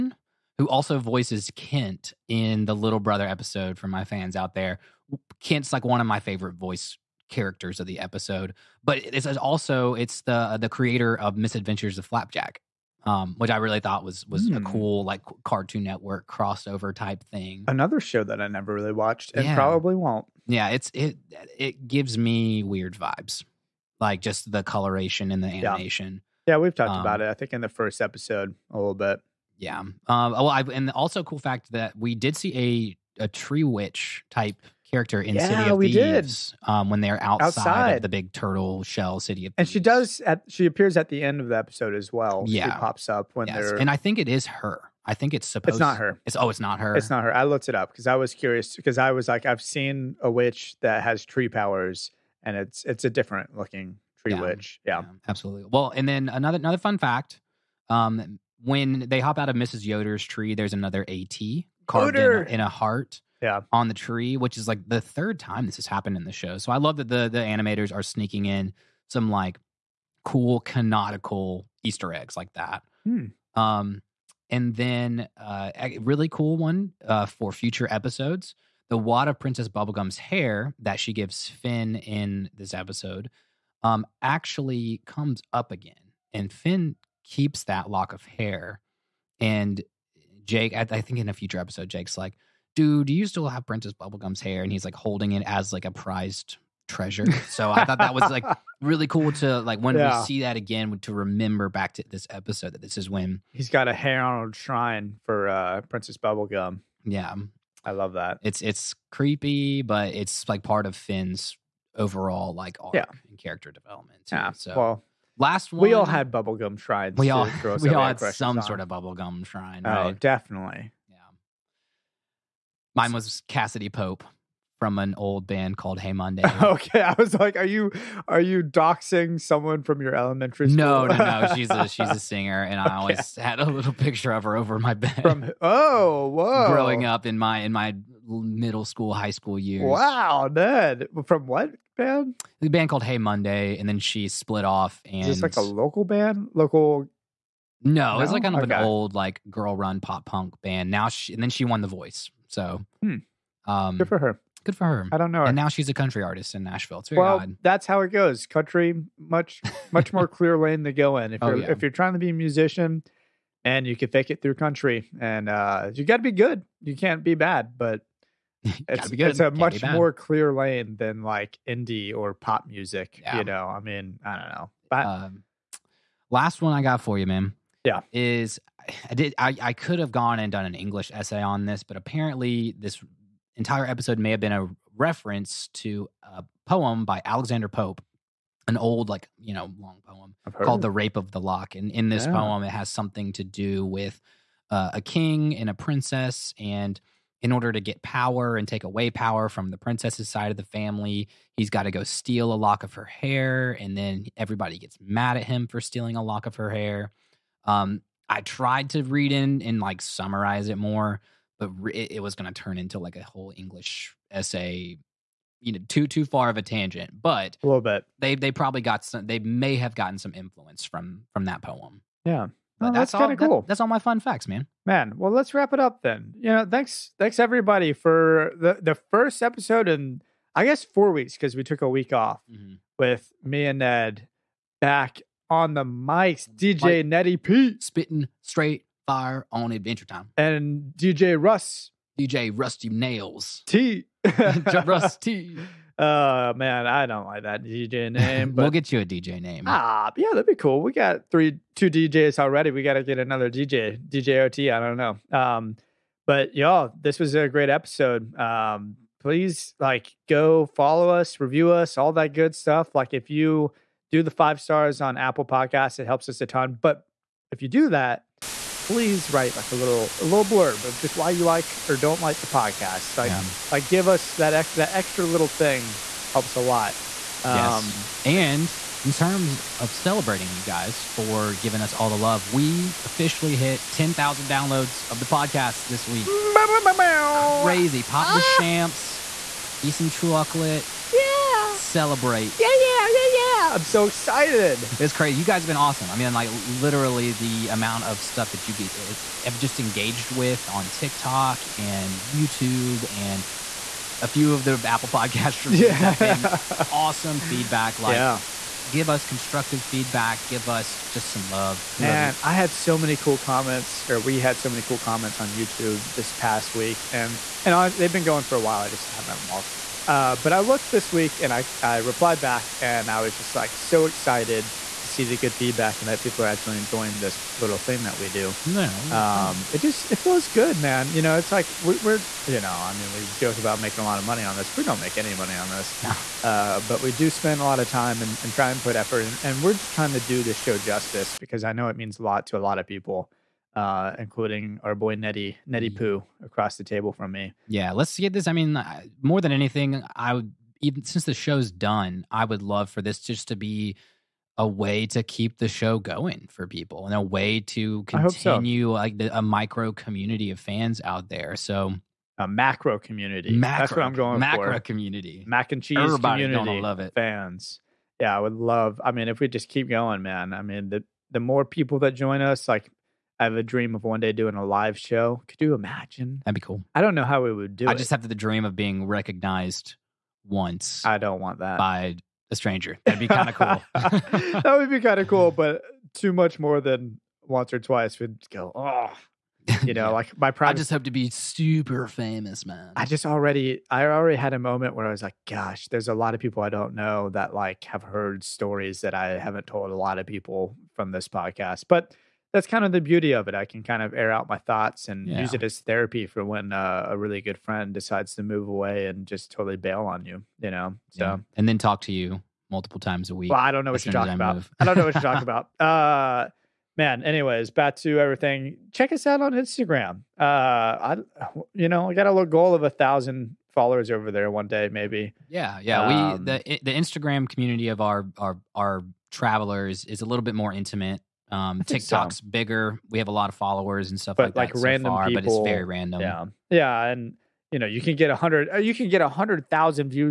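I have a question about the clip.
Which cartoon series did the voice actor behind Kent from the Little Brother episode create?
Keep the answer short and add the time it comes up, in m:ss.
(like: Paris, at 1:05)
Misadventures of Flapjack, at 0:11.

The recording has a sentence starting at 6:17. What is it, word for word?
just have the dream of being recognized once I don't want that.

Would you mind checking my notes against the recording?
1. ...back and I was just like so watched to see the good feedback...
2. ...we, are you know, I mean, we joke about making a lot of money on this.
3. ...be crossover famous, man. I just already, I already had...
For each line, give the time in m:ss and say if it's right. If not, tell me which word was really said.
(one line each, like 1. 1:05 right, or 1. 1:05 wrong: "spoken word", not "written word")
1. 5:22 wrong: "excited", not "watched"
2. 5:31 right
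3. 6:31 wrong: "super", not "crossover".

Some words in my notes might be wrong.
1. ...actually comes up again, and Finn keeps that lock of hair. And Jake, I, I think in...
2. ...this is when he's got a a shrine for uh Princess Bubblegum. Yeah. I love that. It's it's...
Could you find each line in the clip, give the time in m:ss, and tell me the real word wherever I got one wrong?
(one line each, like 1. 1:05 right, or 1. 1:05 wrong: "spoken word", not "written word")
1. 1:24 right
2. 1:42 right.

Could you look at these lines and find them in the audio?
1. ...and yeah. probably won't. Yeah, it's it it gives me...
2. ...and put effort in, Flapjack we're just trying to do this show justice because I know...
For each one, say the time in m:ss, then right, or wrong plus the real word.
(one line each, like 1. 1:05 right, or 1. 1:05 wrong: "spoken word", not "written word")
1. 0:19 right
2. 5:38 wrong: "And", not "Flapjack".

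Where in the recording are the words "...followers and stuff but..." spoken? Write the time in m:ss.
7:13.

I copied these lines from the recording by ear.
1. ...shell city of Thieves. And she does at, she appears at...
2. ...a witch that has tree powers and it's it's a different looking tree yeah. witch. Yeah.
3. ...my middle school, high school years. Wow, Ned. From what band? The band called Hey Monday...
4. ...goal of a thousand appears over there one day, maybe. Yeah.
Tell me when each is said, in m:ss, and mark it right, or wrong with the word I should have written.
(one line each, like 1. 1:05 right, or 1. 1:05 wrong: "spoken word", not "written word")
1. 0:38 right
2. 0:50 right
3. 2:17 right
4. 7:02 wrong: "followers", not "appears".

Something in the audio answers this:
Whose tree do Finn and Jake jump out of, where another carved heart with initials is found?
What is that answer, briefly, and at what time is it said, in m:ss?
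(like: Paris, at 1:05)
Mrs. Yoder, at 0:59.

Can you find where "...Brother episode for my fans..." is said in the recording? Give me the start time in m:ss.
0:02.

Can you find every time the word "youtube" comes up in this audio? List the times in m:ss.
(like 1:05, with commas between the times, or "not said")
5:02, 5:15.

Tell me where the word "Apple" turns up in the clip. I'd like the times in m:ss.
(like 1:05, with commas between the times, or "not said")
4:25, 5:04.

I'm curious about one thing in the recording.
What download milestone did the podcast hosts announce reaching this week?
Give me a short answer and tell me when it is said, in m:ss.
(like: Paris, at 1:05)
10,000, at 4:43.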